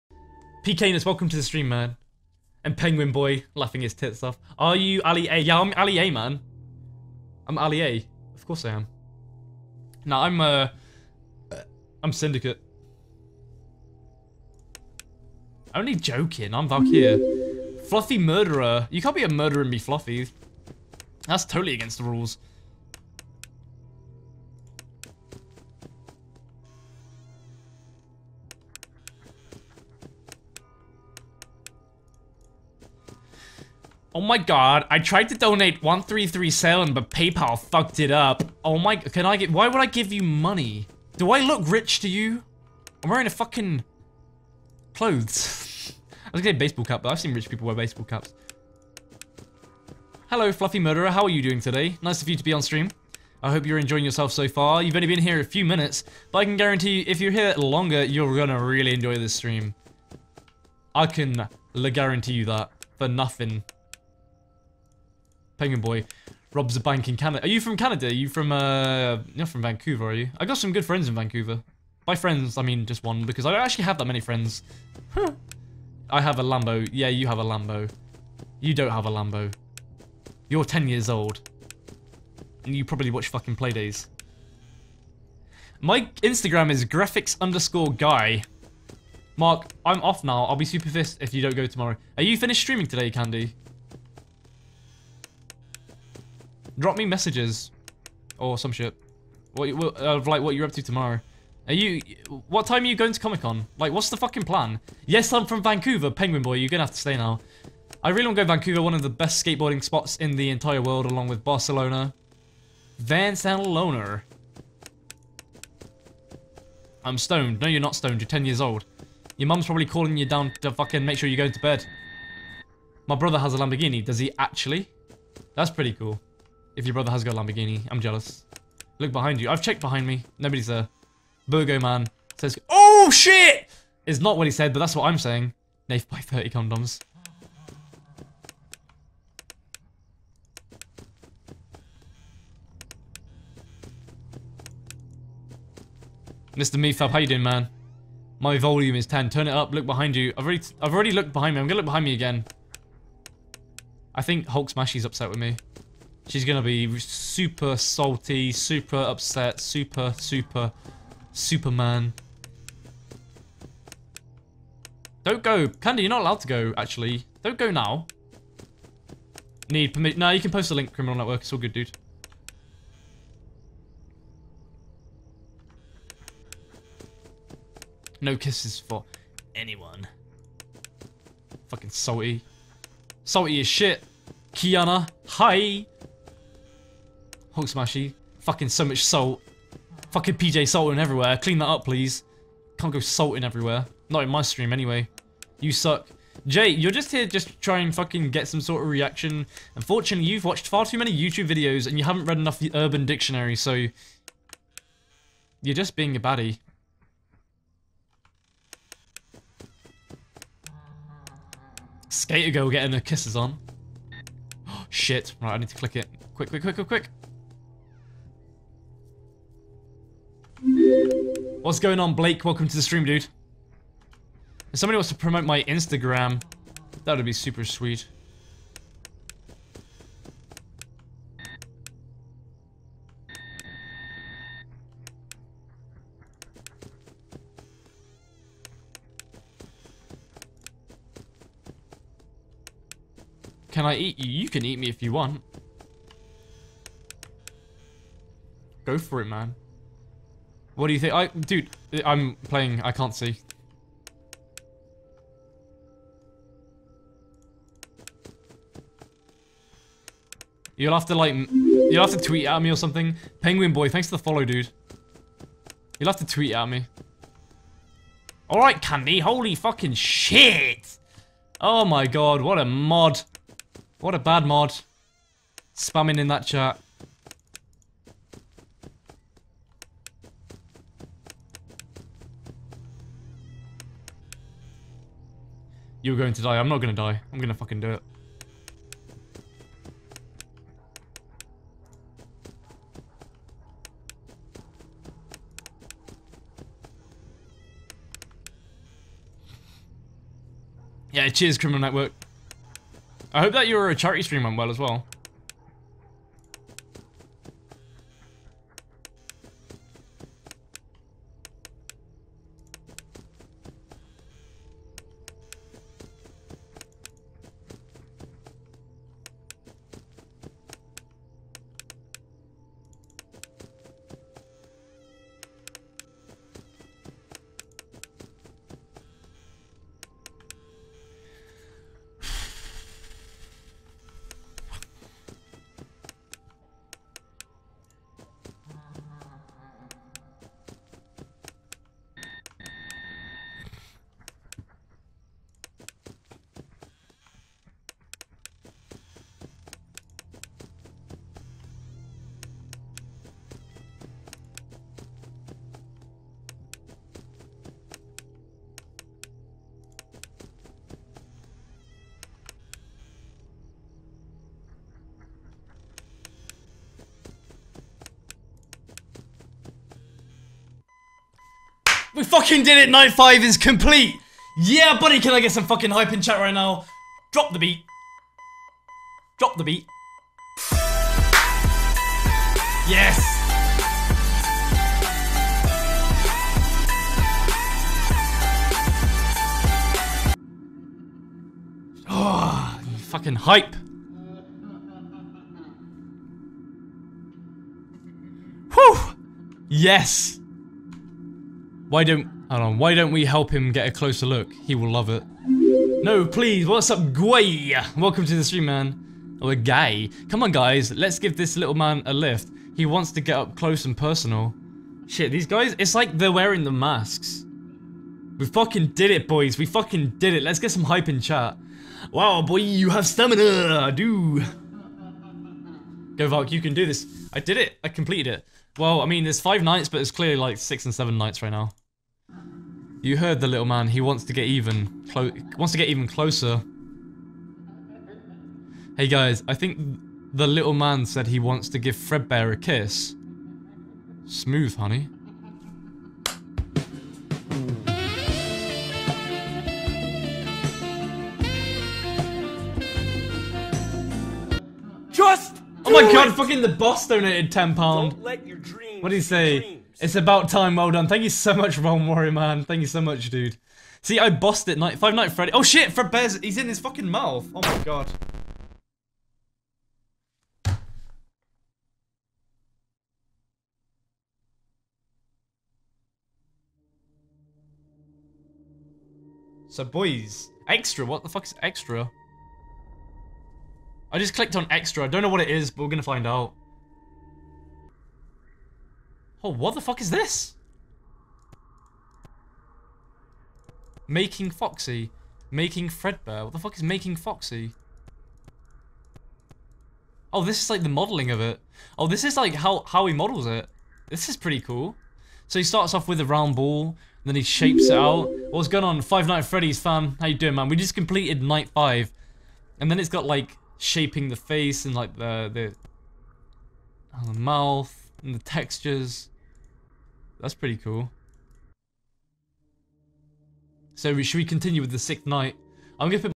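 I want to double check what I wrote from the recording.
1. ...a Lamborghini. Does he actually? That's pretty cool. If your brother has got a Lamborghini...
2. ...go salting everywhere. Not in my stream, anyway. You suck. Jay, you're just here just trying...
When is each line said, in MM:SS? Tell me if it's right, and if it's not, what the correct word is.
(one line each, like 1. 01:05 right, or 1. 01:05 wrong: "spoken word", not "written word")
1. 02:03 right
2. 03:12 right.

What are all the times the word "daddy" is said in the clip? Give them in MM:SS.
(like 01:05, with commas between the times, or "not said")
not said.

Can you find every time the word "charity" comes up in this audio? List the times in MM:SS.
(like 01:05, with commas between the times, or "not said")
05:03.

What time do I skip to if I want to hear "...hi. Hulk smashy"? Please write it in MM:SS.
03:05.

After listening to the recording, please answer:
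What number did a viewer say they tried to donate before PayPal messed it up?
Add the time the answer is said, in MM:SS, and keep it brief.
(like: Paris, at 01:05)
1337, at 00:35.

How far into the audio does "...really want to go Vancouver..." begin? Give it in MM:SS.
01:48.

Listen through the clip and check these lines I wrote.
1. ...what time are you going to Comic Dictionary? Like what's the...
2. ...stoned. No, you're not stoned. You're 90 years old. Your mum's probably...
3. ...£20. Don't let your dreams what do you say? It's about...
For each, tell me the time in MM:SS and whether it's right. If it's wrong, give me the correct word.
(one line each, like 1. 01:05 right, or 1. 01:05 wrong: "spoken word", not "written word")
1. 01:42 wrong: "Con", not "Dictionary"
2. 01:57 wrong: "10", not "90"
3. 07:37 wrong: "10", not "20".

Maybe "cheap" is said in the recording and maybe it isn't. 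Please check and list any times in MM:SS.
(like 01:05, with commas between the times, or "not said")
not said.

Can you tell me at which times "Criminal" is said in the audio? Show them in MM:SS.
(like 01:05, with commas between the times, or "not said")
02:50, 05:01.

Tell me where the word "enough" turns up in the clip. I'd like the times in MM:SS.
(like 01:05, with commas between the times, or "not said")
03:22.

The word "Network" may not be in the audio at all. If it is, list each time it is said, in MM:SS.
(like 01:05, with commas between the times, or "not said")
02:51, 05:01.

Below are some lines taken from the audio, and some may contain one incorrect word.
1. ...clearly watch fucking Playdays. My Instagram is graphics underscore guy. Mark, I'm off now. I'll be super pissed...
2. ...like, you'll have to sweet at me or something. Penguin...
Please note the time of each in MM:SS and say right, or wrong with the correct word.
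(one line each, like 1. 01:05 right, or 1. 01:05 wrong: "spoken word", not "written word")
1. 01:22 wrong: "probably", not "clearly"
2. 04:21 wrong: "tweet", not "sweet".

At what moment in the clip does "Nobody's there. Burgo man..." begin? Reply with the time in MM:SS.
02:10.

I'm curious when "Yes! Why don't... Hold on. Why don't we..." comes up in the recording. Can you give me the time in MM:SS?
06:39.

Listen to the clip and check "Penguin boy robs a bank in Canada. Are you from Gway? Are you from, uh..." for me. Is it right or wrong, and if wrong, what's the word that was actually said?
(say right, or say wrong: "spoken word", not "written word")
wrong: "Canada", not "Gway".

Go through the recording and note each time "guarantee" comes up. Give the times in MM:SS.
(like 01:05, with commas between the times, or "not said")
00:56, 01:01.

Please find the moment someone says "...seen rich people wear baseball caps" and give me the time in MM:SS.
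00:47.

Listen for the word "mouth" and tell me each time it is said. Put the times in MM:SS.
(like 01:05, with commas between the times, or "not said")
07:47, 08:37.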